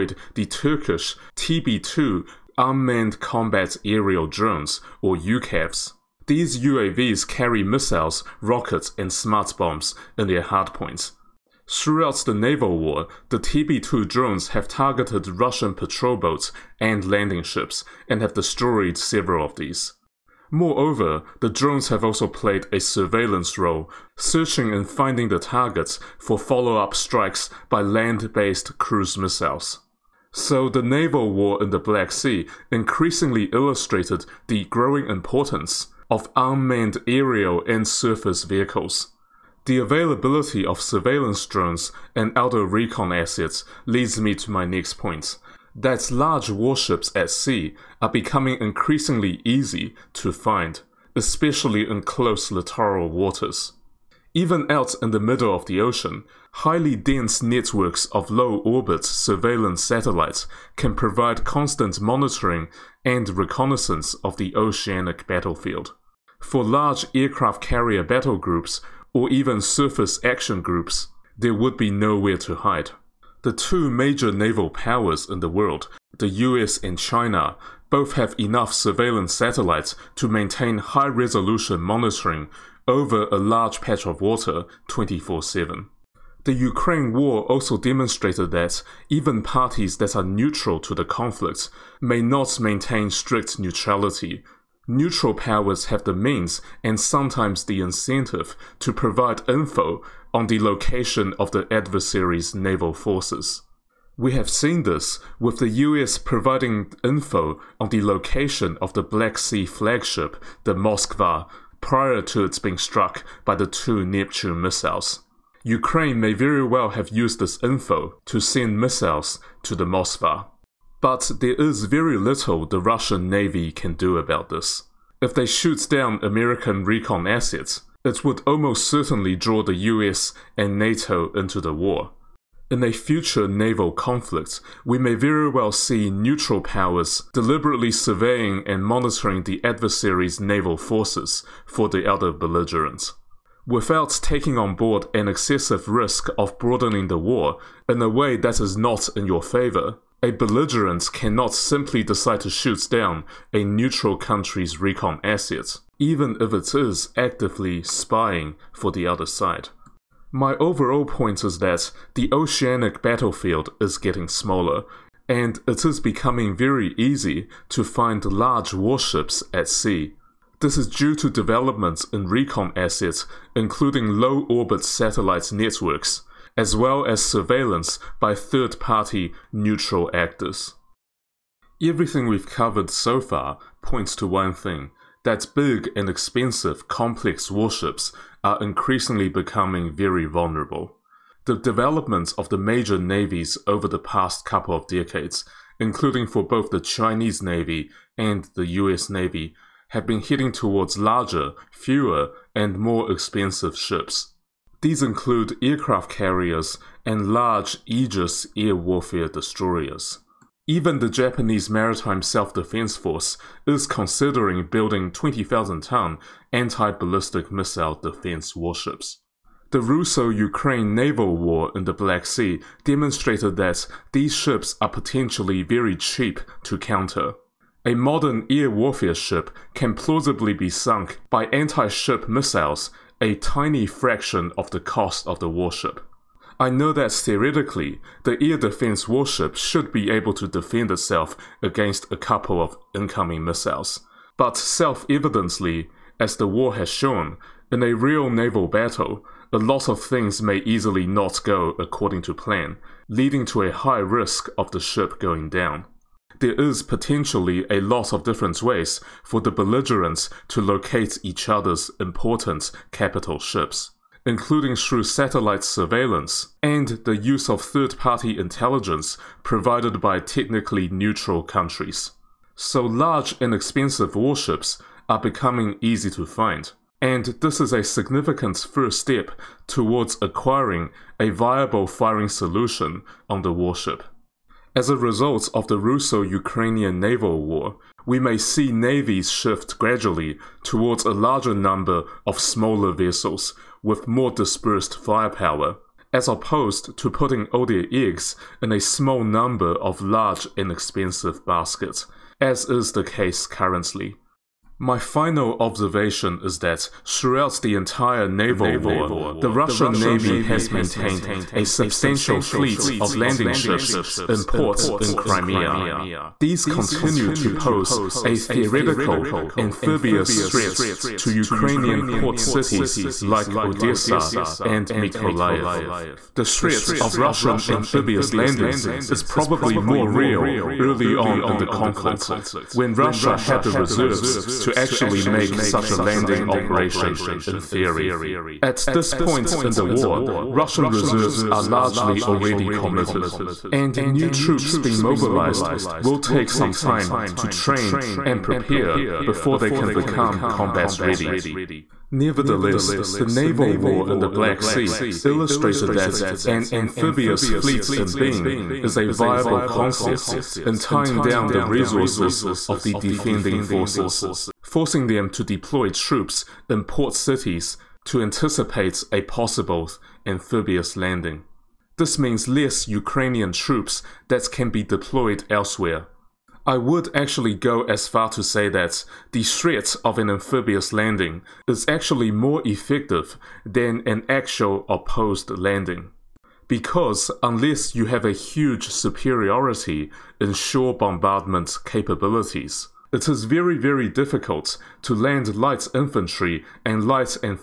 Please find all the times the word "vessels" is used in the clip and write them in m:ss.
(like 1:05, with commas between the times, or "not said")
4:52.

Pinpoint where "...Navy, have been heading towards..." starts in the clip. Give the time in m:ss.
3:19.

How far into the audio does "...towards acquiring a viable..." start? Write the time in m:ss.
4:39.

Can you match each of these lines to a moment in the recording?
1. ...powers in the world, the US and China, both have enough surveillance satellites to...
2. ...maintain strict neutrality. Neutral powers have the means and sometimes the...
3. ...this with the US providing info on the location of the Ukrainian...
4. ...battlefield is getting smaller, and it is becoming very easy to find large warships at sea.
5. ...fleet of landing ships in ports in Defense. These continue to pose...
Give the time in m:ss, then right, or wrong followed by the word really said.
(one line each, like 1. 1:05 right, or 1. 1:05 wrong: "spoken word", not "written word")
1. 1:14 right
2. 1:32 right
3. 1:44 wrong: "Black", not "Ukrainian"
4. 2:43 right
5. 5:12 wrong: "Crimea", not "Defense".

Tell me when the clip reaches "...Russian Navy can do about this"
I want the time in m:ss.
2:02.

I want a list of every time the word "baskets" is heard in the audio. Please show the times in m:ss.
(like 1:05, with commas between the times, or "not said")
5:01.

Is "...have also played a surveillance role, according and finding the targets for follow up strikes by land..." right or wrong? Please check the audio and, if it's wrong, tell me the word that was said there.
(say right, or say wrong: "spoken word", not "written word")
wrong: "searching", not "according".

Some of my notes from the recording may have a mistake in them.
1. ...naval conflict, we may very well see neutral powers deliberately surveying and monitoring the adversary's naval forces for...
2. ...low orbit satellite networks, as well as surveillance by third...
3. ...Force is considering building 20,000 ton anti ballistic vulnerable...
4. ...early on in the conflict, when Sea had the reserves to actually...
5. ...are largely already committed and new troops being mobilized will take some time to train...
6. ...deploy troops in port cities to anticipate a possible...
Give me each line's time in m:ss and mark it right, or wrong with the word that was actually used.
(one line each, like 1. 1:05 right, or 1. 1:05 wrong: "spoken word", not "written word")
1. 2:13 right
2. 2:54 right
3. 3:32 wrong: "missile", not "vulnerable"
4. 5:30 wrong: "Russia", not "Sea"
5. 5:41 right
6. 6:05 right.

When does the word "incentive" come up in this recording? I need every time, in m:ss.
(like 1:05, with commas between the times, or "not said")
1:37.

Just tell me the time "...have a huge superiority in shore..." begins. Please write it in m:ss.
6:28.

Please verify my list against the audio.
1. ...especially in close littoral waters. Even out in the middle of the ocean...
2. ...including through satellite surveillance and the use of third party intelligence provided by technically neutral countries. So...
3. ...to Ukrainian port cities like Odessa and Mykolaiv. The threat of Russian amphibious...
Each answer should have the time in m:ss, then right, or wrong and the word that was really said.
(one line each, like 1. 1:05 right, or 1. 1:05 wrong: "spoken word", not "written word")
1. 0:51 right
2. 4:24 right
3. 5:21 right.